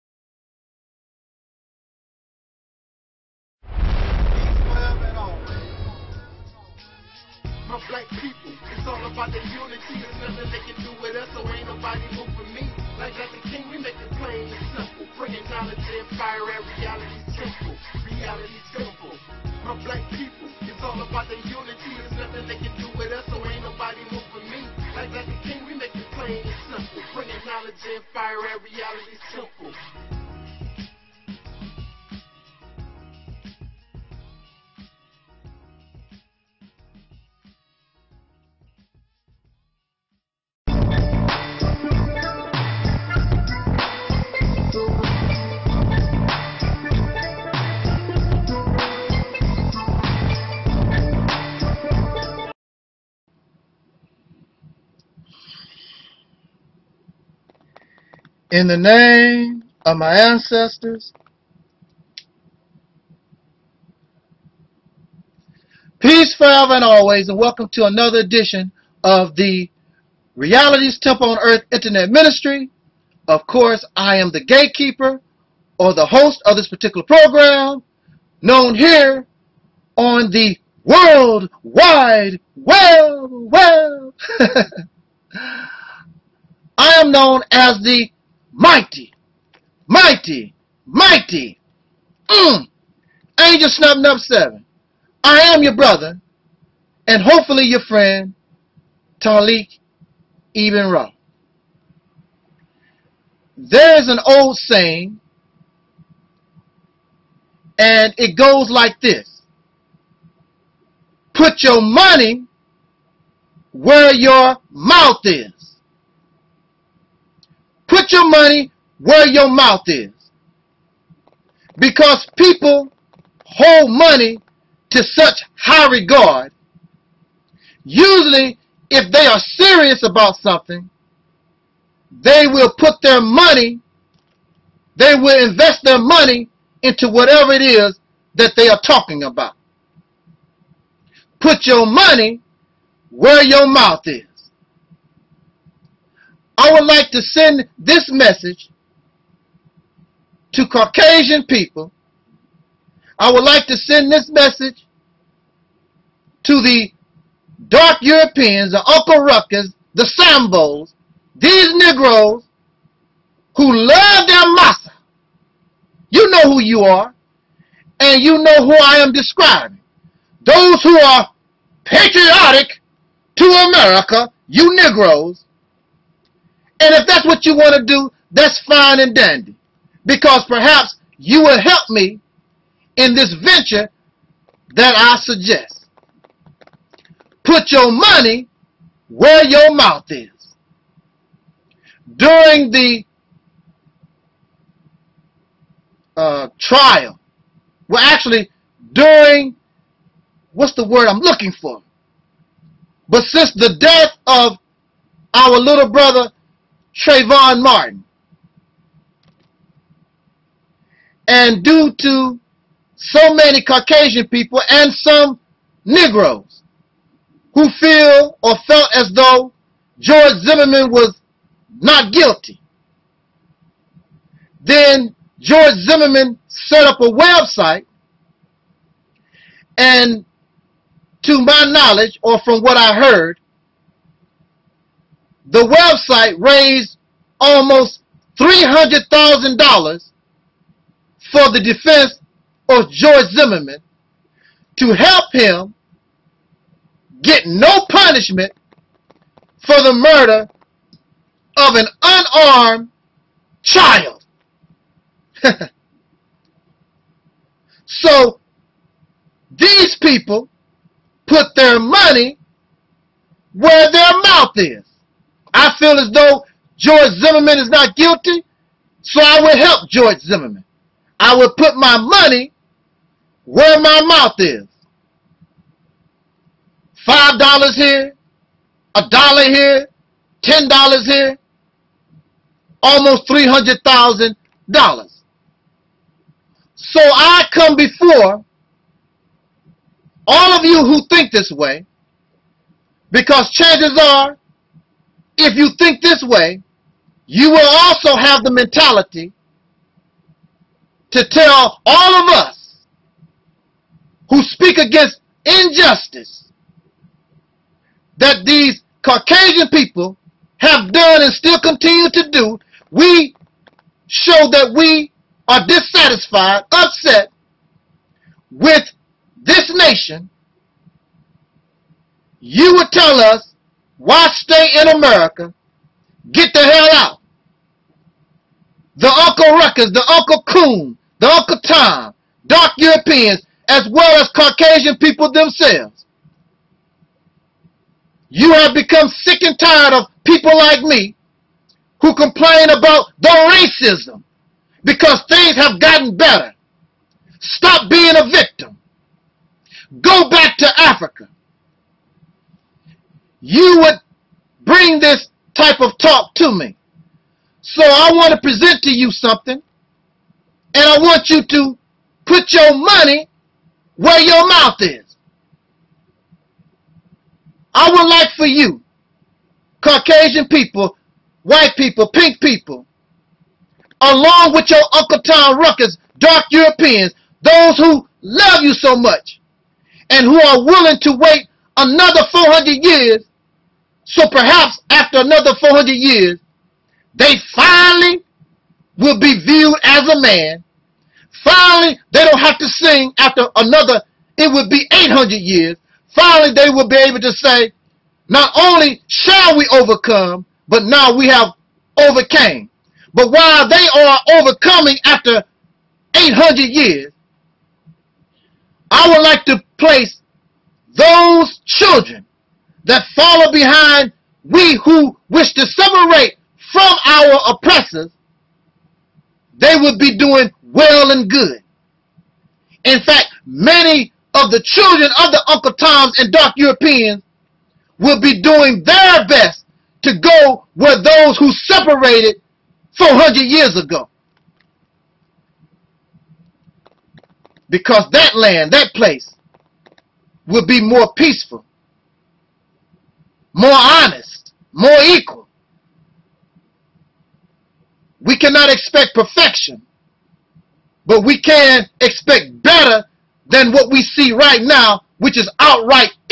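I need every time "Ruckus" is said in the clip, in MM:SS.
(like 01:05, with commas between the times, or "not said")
02:39, 05:29, 06:15.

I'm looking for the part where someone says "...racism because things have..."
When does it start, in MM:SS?
05:43.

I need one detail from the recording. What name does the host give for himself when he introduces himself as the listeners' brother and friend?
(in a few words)
Taalik Ibn Ra.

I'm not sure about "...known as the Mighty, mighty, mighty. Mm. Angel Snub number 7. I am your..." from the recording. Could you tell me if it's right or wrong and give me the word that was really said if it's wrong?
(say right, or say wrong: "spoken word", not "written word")
right.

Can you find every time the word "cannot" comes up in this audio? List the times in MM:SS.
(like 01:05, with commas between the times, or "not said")
07:28.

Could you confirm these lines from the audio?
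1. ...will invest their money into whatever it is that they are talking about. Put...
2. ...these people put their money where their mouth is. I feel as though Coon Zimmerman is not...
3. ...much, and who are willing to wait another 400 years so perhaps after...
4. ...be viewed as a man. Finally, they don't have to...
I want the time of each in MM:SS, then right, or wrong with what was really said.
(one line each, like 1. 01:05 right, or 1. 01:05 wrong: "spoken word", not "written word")
1. 02:15 right
2. 04:19 wrong: "George", not "Coon"
3. 06:18 right
4. 06:29 right.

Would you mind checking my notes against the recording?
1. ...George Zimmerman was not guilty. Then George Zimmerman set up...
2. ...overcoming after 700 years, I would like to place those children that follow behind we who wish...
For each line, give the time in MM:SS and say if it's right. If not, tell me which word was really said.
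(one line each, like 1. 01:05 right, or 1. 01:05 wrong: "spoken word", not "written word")
1. 03:39 right
2. 06:44 wrong: "800", not "700".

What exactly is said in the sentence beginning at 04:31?
I will put my money where my mouth is.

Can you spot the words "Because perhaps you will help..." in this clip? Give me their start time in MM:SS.
03:00.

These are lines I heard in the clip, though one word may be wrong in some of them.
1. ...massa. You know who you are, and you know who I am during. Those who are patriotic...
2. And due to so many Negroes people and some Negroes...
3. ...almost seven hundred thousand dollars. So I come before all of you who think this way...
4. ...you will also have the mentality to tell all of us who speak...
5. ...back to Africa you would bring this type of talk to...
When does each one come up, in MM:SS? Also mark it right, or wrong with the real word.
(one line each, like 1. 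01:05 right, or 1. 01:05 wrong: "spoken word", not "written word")
1. 02:44 wrong: "describing", not "during"
2. 03:31 wrong: "Caucasian", not "Negroes"
3. 04:42 wrong: "three", not "seven"
4. 04:57 right
5. 05:50 right.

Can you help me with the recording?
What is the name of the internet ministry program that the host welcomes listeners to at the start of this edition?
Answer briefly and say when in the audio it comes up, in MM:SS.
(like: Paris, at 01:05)
Reality's Temple on Earth Internet Ministry, at 01:10.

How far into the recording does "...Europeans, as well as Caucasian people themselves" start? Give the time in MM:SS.
05:32.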